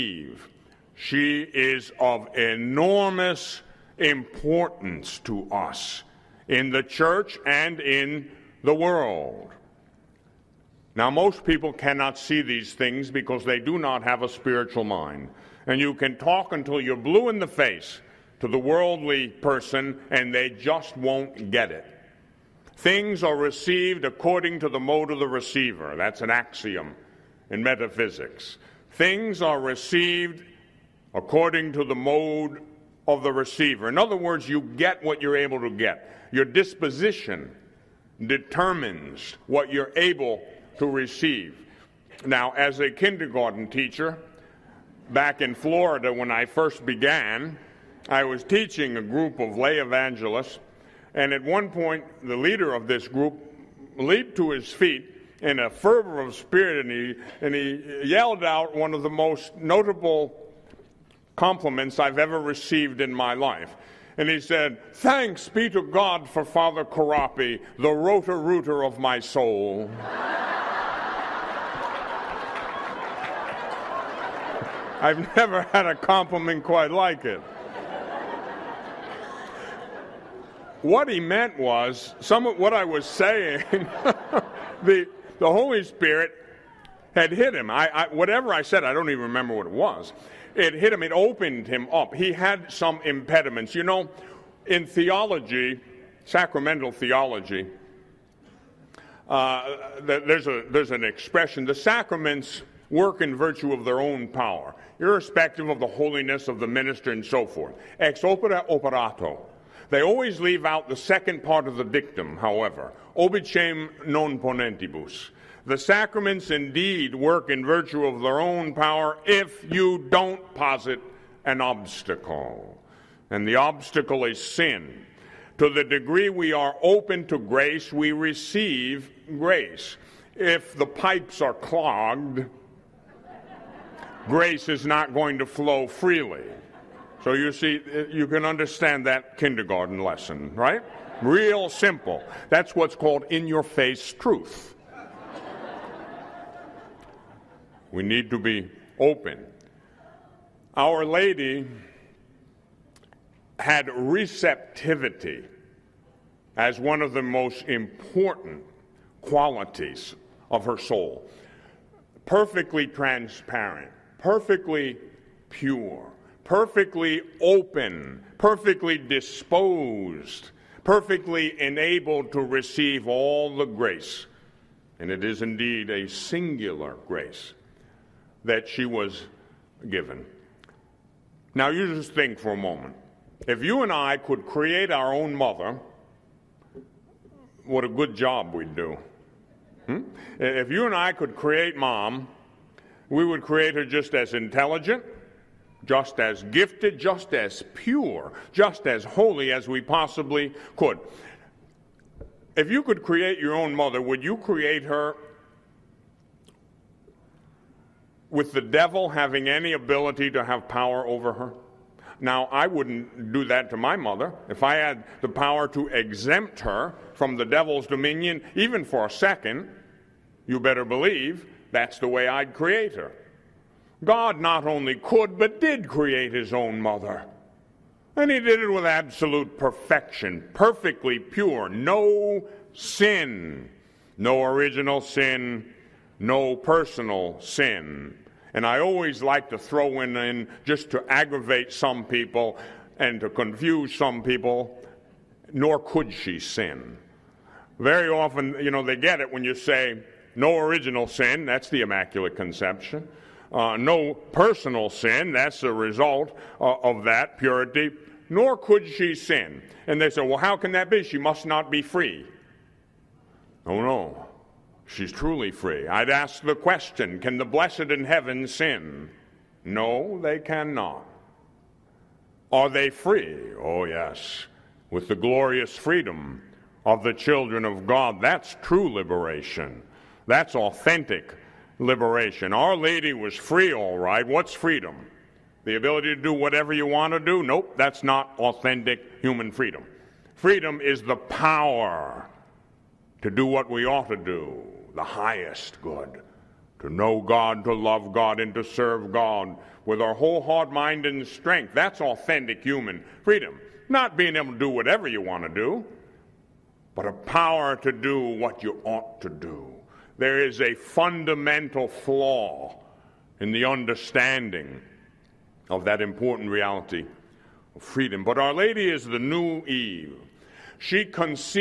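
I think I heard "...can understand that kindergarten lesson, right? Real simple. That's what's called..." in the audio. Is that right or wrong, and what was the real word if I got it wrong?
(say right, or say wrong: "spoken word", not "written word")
right.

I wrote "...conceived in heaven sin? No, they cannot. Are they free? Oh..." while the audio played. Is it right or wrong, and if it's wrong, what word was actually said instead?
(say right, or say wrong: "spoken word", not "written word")
wrong: "blessed", not "conceived".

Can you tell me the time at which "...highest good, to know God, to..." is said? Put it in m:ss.
4:55.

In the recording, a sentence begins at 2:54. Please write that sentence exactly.
And it is indeed a singular grace that she was given.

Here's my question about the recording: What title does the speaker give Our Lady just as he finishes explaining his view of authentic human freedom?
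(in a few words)
The new Eve.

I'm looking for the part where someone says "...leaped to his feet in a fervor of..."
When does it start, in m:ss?
0:53.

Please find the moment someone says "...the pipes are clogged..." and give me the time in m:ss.
2:10.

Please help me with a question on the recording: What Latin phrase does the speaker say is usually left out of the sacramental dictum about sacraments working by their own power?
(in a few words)
obicem non ponentibus.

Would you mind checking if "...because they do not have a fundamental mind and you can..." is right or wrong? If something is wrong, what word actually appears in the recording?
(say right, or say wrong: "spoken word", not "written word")
wrong: "spiritual", not "fundamental".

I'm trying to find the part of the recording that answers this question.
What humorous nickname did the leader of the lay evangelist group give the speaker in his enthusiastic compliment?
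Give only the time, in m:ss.
1:07.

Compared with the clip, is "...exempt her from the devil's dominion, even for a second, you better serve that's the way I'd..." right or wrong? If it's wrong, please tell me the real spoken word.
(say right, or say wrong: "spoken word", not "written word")
wrong: "believe", not "serve".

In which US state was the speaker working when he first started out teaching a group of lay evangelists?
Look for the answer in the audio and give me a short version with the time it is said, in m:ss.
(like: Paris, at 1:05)
Florida, at 0:45.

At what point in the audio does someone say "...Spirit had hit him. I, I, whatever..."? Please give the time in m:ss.
1:25.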